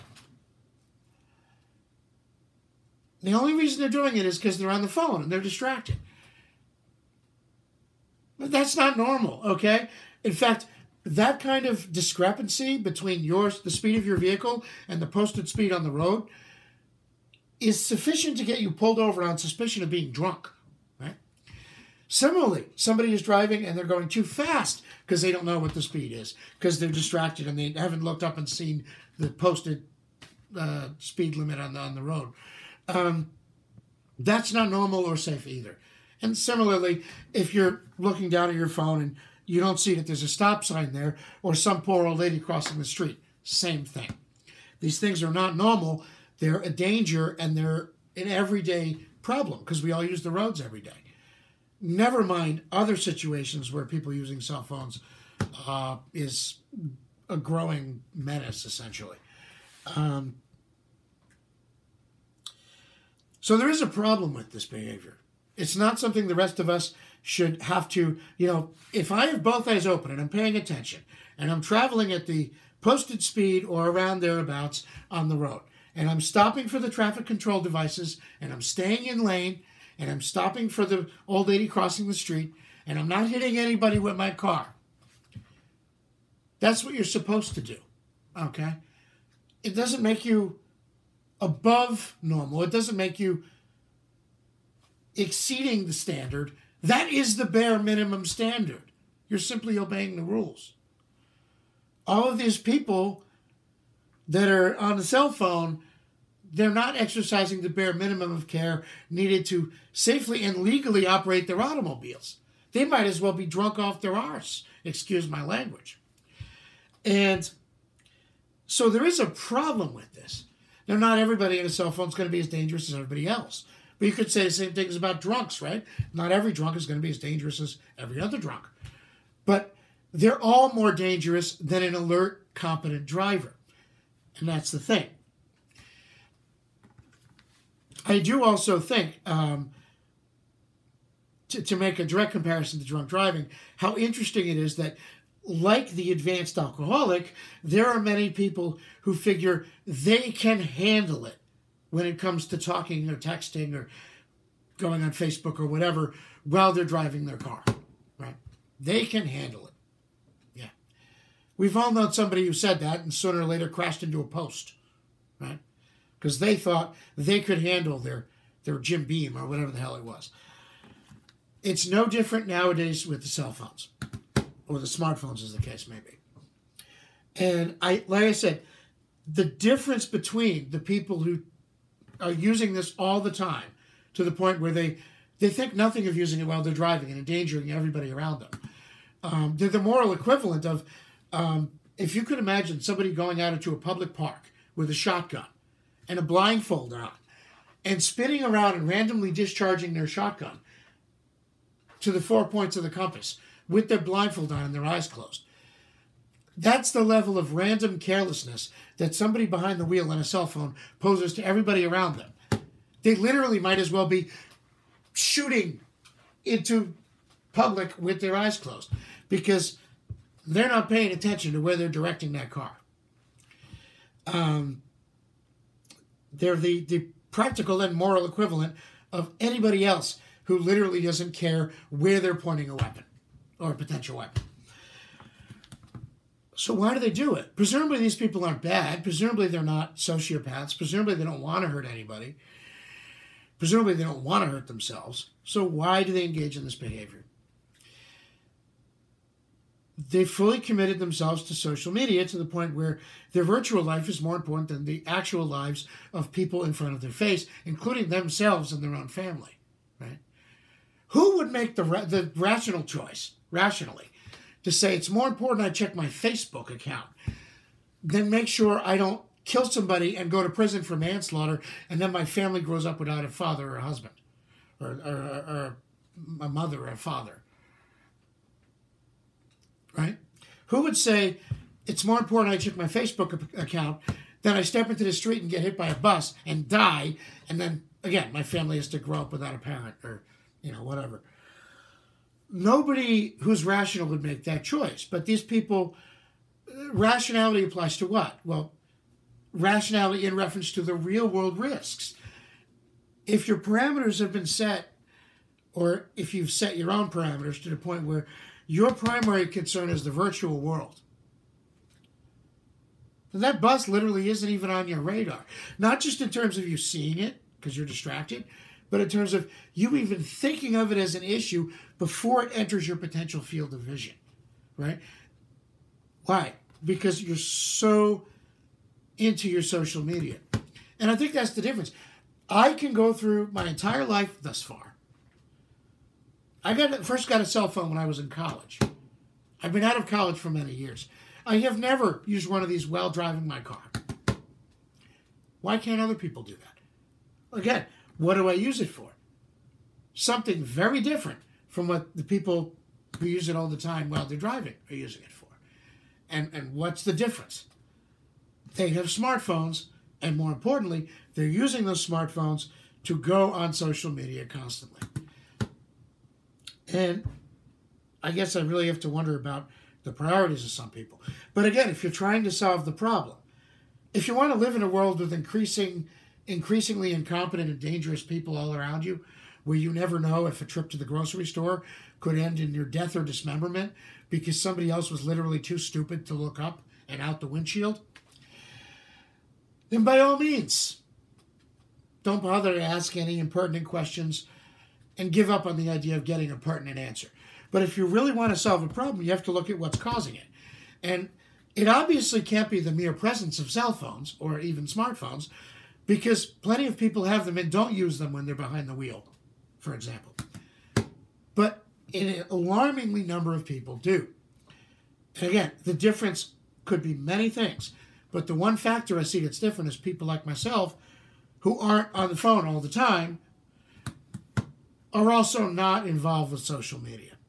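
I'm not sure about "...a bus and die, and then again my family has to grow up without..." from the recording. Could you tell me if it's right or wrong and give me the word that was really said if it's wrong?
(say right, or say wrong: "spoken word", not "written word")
right.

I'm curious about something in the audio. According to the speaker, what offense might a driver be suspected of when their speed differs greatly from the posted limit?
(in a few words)
Being drunk.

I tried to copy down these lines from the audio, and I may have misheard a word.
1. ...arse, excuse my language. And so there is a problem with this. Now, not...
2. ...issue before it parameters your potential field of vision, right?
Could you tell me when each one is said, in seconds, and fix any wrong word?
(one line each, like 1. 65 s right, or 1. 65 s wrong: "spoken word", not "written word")
1. 114 s right
2. 321 s wrong: "enters", not "parameters".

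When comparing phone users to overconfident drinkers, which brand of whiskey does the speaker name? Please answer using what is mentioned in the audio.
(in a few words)
Jim Beam.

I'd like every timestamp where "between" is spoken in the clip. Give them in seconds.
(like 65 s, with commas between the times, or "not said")
12 s, 180 s.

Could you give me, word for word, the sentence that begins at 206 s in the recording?
That's the level of random carelessness that somebody behind the wheel on a cell phone poses to everybody around them.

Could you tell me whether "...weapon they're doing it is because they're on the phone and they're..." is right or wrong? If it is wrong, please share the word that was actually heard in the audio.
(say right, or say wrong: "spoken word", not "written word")
wrong: "reason", not "weapon".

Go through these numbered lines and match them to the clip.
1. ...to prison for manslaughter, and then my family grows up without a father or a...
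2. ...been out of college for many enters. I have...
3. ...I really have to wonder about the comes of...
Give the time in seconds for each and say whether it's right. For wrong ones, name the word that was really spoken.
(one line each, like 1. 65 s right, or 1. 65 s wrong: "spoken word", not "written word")
1. 270 s right
2. 339 s wrong: "years", not "enters"
3. 368 s wrong: "priorities", not "comes".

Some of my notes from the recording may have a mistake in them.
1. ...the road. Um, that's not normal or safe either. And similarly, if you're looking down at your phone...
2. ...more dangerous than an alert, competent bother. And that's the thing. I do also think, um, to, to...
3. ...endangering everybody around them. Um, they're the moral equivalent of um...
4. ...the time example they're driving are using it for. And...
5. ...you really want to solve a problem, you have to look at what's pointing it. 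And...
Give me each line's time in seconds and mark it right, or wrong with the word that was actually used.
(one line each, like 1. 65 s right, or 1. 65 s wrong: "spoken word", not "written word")
1. 31 s right
2. 130 s wrong: "driver", not "bother"
3. 187 s right
4. 353 s wrong: "while", not "example"
5. 397 s wrong: "causing", not "pointing".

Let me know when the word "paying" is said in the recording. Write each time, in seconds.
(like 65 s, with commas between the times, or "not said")
70 s, 220 s.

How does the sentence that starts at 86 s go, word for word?
That's what you're supposed to do, okay?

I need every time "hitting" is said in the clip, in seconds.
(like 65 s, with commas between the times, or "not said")
83 s.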